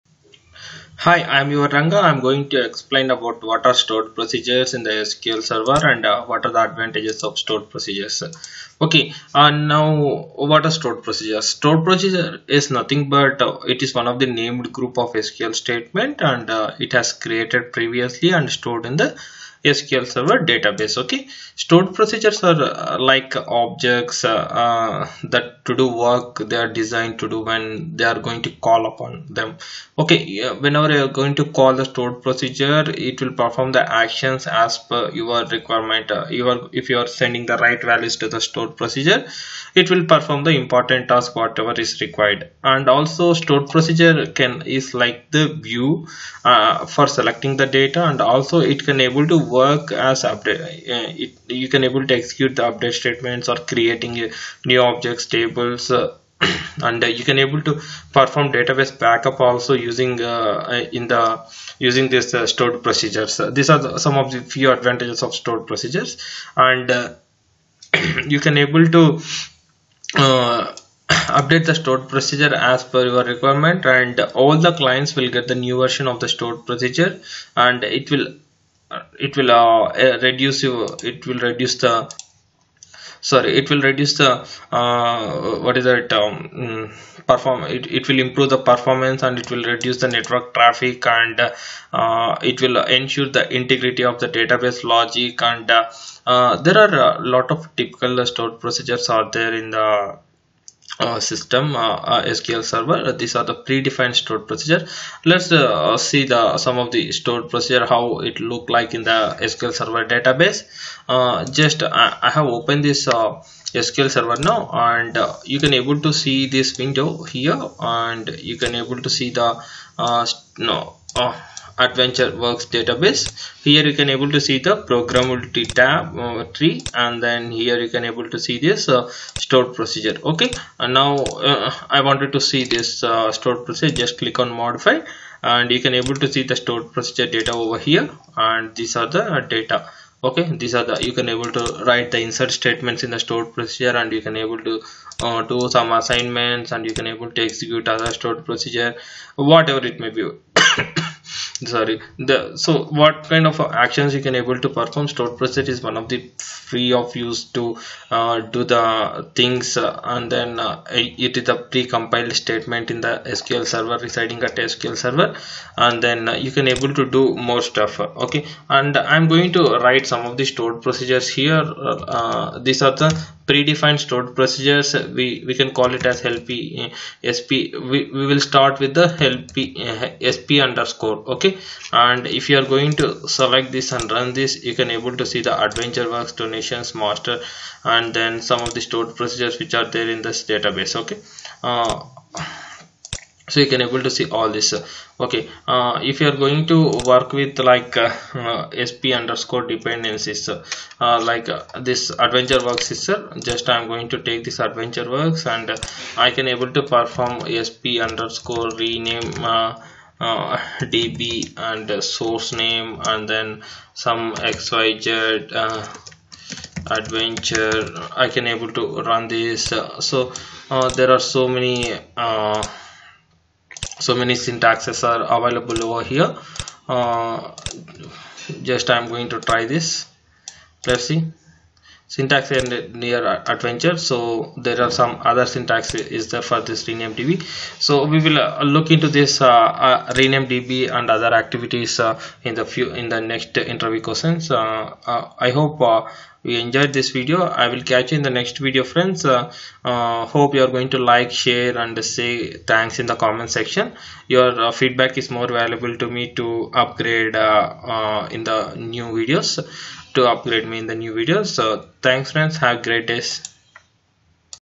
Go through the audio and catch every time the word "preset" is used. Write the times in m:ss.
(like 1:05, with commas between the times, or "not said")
2:35.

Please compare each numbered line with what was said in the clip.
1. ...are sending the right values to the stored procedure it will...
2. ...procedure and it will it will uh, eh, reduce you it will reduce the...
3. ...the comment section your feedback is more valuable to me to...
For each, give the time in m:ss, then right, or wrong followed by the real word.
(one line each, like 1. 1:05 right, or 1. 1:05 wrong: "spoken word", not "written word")
1. 0:36 right
2. 1:16 right
3. 4:13 right.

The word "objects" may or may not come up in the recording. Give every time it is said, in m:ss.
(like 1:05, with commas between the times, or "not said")
0:23, 0:54.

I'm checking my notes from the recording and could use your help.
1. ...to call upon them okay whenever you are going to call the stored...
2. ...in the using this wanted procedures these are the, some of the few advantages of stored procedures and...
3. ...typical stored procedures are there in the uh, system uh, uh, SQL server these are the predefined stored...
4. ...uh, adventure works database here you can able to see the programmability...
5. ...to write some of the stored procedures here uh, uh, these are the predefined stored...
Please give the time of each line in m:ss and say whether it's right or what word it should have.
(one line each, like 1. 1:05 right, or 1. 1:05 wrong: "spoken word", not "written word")
1. 0:28 right
2. 1:00 wrong: "stored", not "wanted"
3. 1:37 right
4. 2:01 right
5. 2:49 right.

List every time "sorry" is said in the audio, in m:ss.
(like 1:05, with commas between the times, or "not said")
1:23, 2:31.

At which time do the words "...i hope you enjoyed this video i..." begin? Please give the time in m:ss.
4:05.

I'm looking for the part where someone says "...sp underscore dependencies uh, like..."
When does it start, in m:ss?
3:18.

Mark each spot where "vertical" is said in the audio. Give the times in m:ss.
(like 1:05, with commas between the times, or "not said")
not said.